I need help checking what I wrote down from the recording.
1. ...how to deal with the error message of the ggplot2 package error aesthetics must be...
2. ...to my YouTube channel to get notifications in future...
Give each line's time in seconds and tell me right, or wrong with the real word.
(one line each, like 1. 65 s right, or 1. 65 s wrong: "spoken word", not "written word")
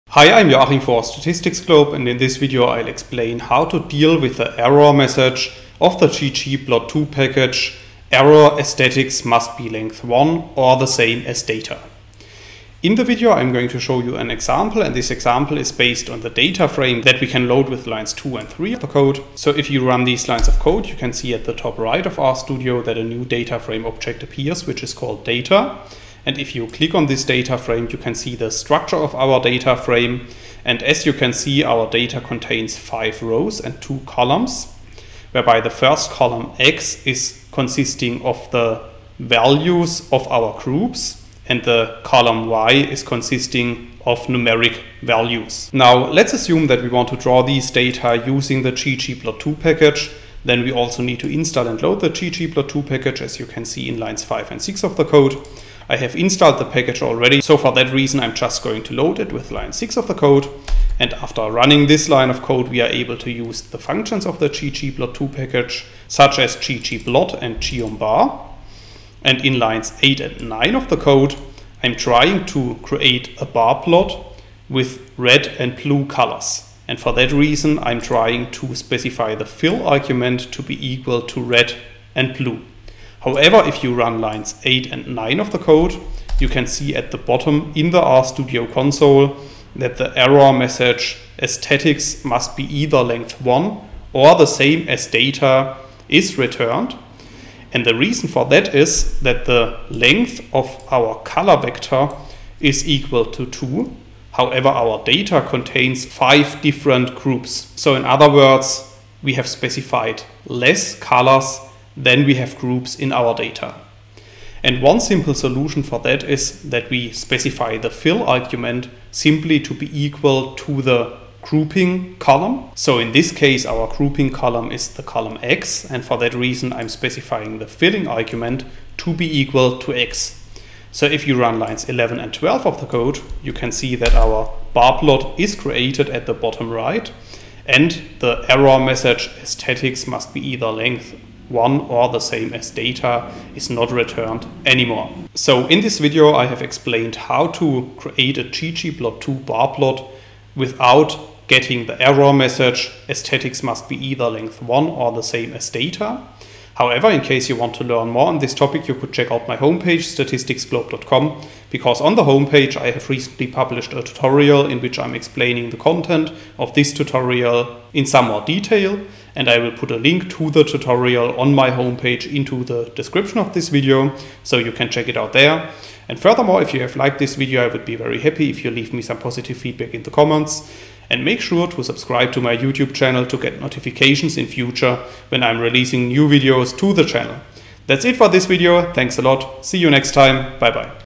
1. 3 s right
2. 182 s right.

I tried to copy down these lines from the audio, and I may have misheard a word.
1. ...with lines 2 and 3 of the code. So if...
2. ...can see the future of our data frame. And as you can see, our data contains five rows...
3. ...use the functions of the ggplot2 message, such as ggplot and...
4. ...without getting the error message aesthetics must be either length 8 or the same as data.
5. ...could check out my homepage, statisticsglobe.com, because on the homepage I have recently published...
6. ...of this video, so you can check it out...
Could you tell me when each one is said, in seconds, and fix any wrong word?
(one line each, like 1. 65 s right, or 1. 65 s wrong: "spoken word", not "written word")
1. 17 s right
2. 27 s wrong: "structure", not "future"
3. 63 s wrong: "package", not "message"
4. 150 s wrong: "1", not "8"
5. 158 s right
6. 173 s right.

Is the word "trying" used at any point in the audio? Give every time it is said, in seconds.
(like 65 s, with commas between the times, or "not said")
71 s, 78 s.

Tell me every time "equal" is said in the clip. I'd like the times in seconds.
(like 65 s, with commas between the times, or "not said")
80 s, 102 s, 119 s, 129 s.